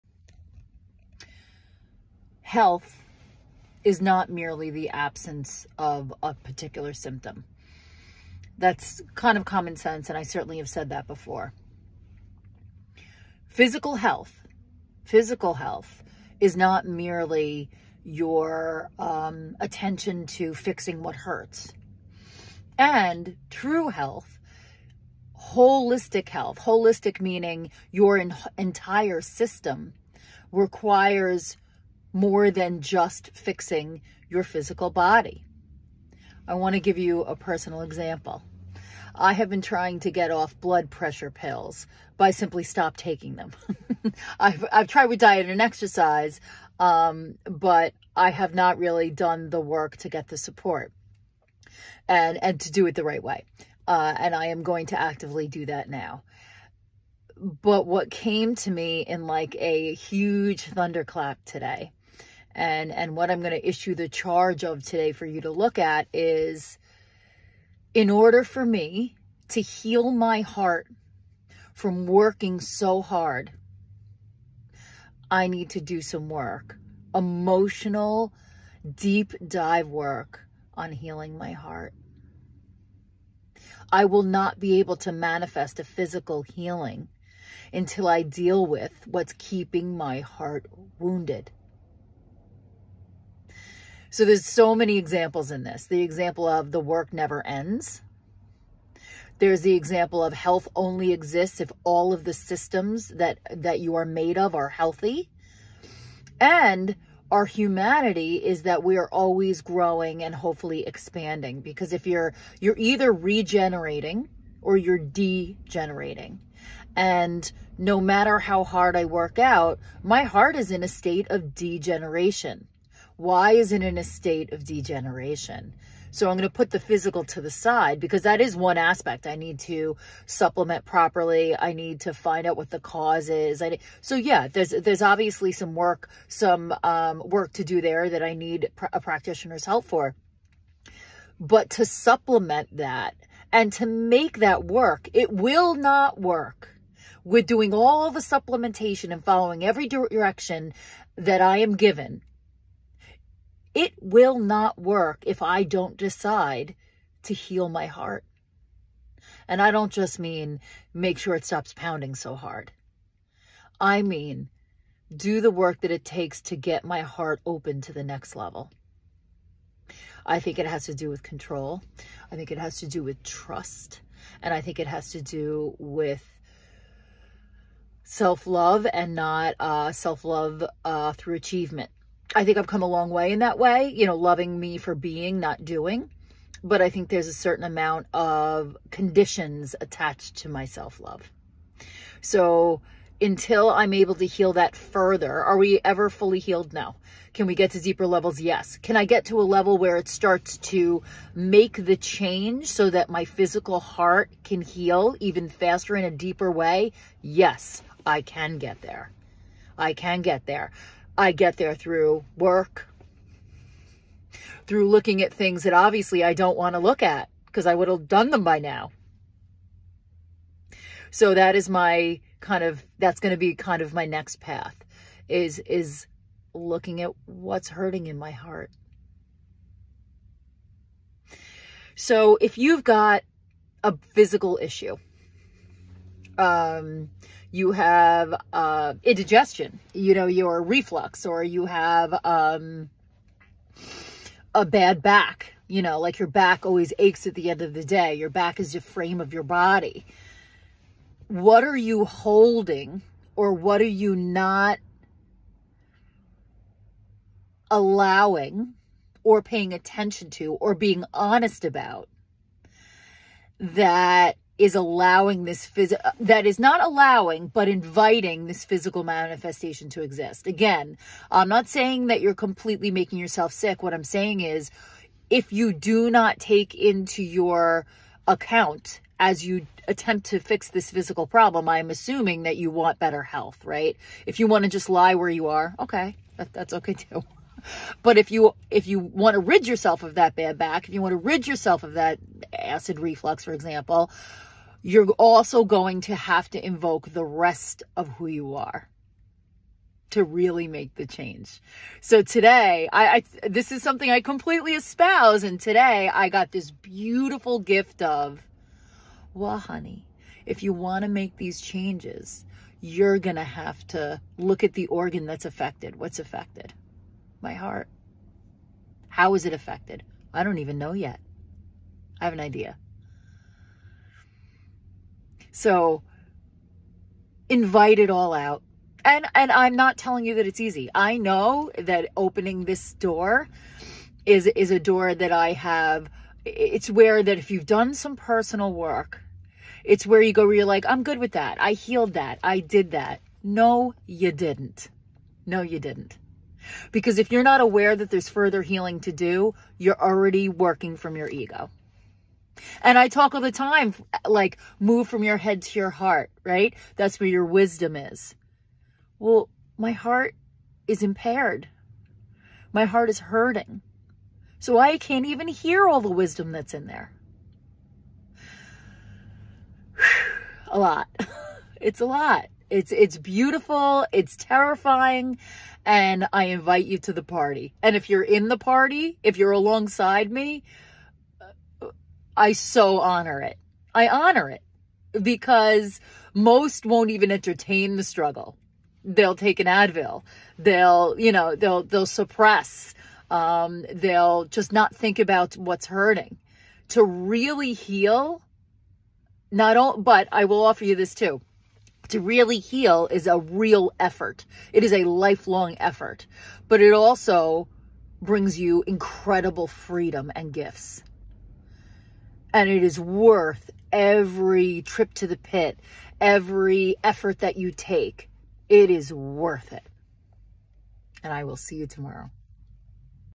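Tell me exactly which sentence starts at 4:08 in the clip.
Your back is the frame of your body.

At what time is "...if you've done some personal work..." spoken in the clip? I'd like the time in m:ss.
5:37.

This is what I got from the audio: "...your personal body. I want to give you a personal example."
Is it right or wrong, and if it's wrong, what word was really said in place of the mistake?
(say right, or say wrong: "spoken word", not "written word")
wrong: "physical", not "personal".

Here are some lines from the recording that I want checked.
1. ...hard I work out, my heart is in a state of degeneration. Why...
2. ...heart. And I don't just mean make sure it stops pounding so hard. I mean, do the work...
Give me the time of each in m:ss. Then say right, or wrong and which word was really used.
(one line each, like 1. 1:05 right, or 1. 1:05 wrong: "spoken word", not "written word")
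1. 1:58 right
2. 2:37 right.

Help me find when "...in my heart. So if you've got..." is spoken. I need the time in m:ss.
3:48.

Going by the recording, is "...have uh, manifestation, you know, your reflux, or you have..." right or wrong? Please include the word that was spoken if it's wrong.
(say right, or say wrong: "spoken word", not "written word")
wrong: "indigestion", not "manifestation".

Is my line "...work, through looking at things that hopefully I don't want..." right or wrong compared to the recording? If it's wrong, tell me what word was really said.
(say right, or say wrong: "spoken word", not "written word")
wrong: "obviously", not "hopefully".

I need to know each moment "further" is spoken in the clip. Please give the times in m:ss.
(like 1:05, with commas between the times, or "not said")
3:14, 5:48.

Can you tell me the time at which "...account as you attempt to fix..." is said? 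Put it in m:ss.
4:38.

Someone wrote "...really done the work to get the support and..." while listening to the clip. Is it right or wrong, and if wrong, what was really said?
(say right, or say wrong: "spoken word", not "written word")
right.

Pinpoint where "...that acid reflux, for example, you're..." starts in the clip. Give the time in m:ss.
4:51.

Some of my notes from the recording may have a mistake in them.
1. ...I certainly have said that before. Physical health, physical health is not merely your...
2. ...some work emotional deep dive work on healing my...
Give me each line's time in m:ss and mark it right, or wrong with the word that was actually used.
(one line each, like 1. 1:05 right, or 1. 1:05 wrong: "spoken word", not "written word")
1. 0:10 right
2. 1:16 right.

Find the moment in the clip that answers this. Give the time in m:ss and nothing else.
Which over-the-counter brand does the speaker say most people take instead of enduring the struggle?
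6:29.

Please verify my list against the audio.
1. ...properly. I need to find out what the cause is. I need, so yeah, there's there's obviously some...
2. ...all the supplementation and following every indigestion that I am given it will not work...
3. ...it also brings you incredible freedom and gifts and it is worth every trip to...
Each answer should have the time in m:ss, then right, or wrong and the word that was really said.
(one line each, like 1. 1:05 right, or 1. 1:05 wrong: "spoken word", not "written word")
1. 2:10 right
2. 2:27 wrong: "direction", not "indigestion"
3. 6:46 right.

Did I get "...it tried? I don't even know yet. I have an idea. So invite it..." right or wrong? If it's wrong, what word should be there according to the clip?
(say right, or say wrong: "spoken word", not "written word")
wrong: "affected", not "tried".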